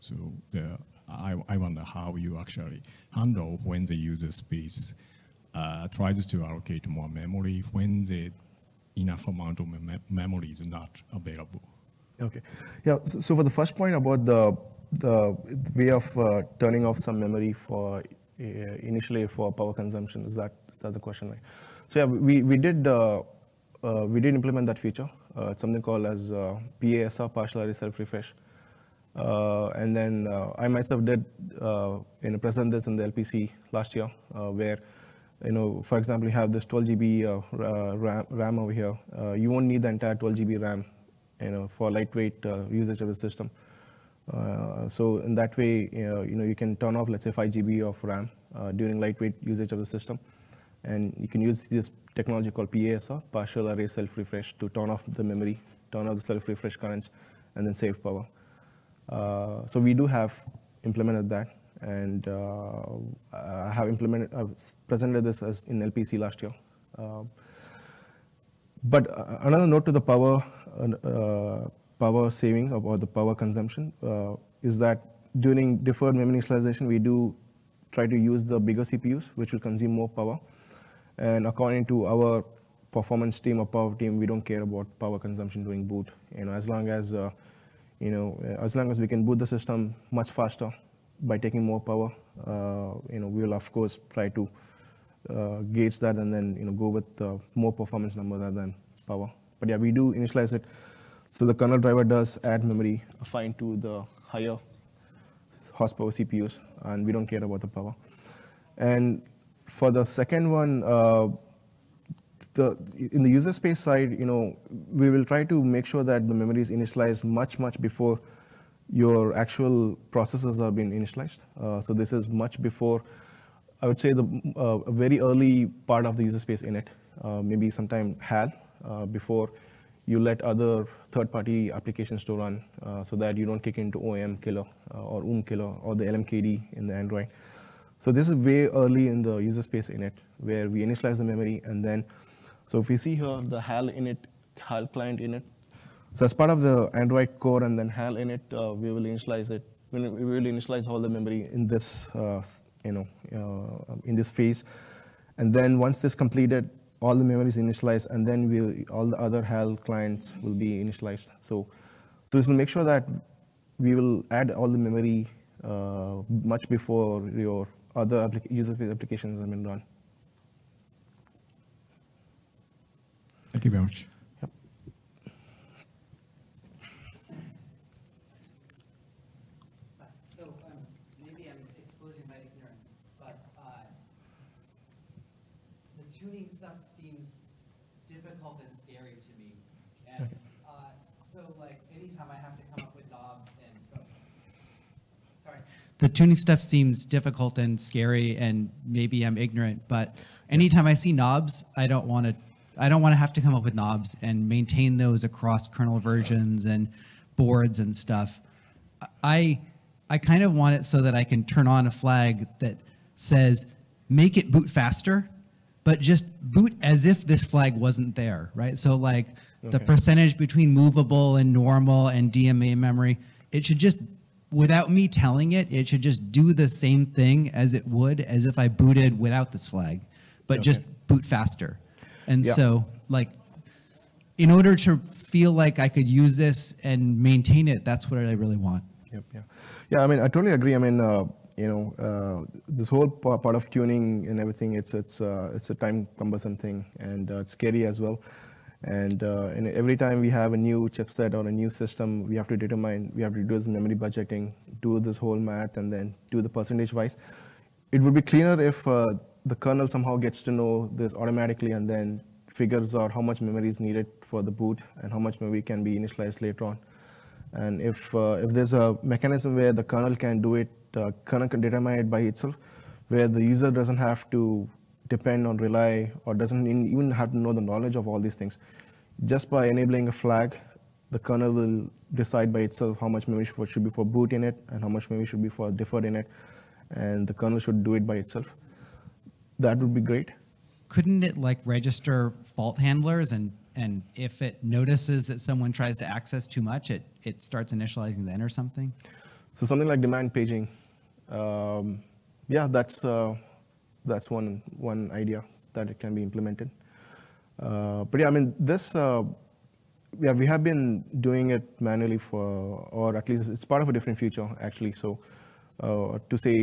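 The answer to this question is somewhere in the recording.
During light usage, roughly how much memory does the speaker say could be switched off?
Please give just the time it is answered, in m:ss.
0:47.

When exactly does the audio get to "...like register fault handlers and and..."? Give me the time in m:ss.
4:51.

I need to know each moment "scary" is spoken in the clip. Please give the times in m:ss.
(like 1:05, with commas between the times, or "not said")
3:17, 4:07.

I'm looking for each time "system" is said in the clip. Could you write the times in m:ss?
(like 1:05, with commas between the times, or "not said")
0:43, 0:49, 1:29, 4:11.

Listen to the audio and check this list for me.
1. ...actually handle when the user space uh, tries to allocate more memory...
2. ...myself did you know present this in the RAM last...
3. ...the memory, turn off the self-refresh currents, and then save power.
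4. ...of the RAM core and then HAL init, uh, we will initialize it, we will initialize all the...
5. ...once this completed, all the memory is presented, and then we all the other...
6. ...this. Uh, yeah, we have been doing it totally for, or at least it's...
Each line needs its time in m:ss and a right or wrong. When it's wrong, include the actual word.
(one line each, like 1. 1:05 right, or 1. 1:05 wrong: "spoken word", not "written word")
1. 0:02 right
2. 0:30 wrong: "LPC", not "RAM"
3. 0:55 right
4. 2:26 wrong: "Android", not "RAM"
5. 2:35 wrong: "initialized", not "presented"
6. 5:08 wrong: "manually", not "totally".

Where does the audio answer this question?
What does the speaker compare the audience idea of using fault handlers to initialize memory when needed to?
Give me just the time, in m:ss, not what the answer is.
5:00.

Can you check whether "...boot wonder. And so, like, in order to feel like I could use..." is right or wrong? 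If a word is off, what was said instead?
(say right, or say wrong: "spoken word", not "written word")
wrong: "faster", not "wonder".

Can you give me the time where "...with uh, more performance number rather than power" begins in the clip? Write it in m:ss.
1:36.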